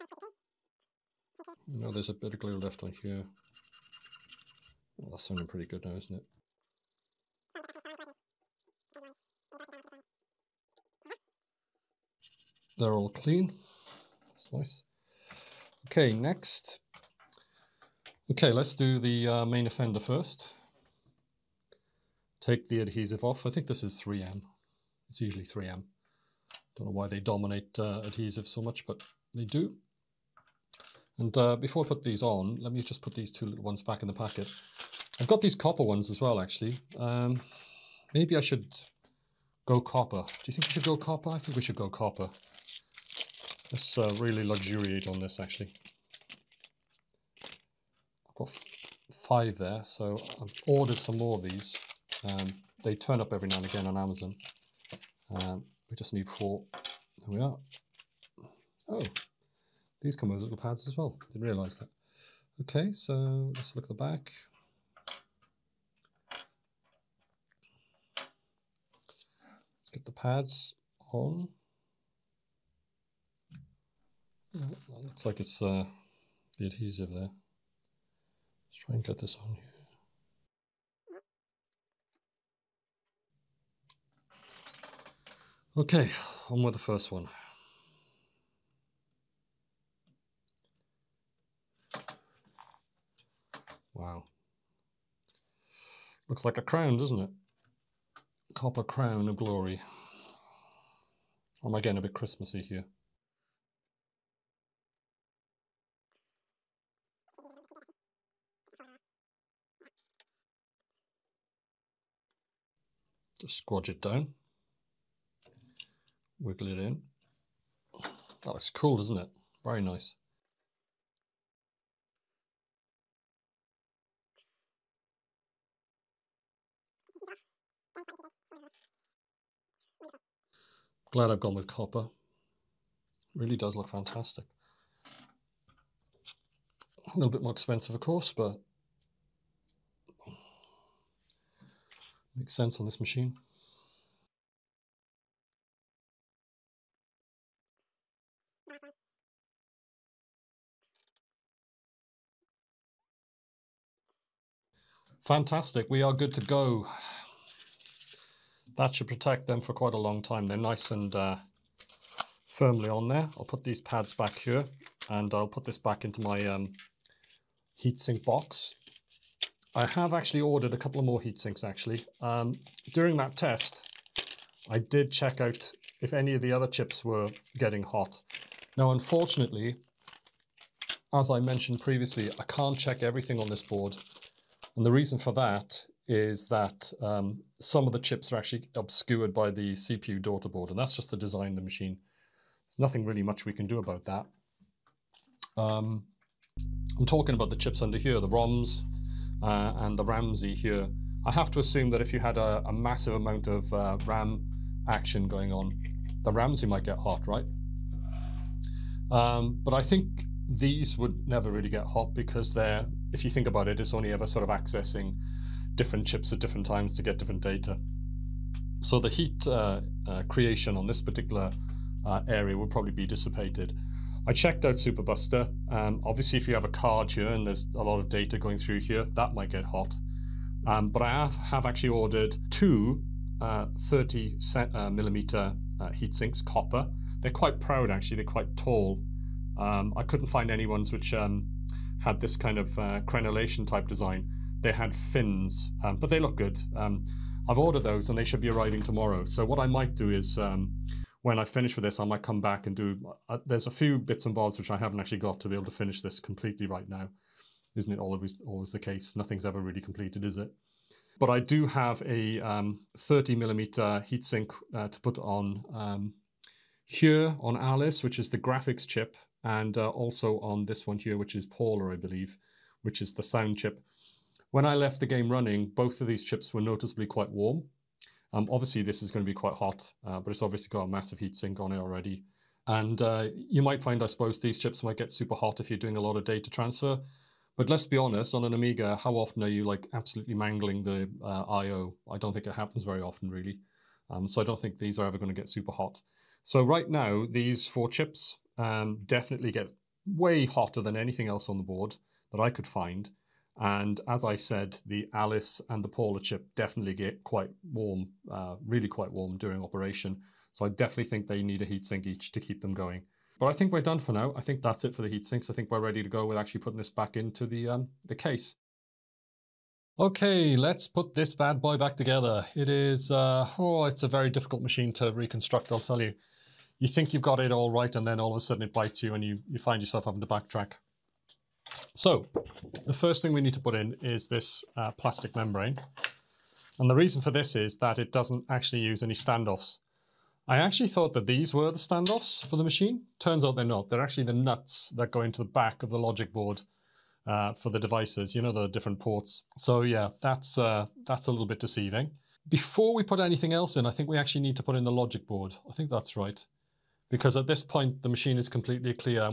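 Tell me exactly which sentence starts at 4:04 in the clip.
They had fins, um, but they look good.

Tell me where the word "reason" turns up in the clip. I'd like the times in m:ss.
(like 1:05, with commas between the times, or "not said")
3:04, 5:36.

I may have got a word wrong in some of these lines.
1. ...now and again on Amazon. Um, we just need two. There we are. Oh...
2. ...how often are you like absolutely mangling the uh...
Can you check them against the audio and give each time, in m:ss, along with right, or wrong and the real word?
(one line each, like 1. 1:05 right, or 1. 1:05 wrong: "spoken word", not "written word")
1. 0:53 wrong: "four", not "two"
2. 4:48 right.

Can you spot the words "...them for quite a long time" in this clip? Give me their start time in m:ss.
2:39.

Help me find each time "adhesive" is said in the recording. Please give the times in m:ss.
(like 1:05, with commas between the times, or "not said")
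0:22, 0:28, 1:16.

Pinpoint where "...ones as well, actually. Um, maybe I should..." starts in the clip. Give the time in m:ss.
0:35.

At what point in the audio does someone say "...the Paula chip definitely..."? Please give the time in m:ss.
5:05.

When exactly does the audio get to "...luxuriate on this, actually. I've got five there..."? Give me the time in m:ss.
0:44.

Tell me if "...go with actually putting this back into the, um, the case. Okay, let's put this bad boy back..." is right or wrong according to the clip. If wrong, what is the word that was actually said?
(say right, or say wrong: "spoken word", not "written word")
right.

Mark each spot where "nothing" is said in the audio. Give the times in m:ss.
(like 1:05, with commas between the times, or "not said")
3:12, 4:19.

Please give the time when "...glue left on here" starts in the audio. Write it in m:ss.
0:02.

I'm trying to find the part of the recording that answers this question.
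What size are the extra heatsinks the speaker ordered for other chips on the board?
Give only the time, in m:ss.
4:22.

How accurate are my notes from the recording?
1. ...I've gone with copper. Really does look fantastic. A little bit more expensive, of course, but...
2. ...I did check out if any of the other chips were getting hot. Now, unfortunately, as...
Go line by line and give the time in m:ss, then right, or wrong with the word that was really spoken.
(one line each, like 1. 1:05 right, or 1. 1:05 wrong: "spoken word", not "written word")
1. 2:11 right
2. 2:54 right.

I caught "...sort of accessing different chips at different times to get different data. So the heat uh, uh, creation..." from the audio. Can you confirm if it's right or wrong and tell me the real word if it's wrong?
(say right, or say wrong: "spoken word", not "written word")
right.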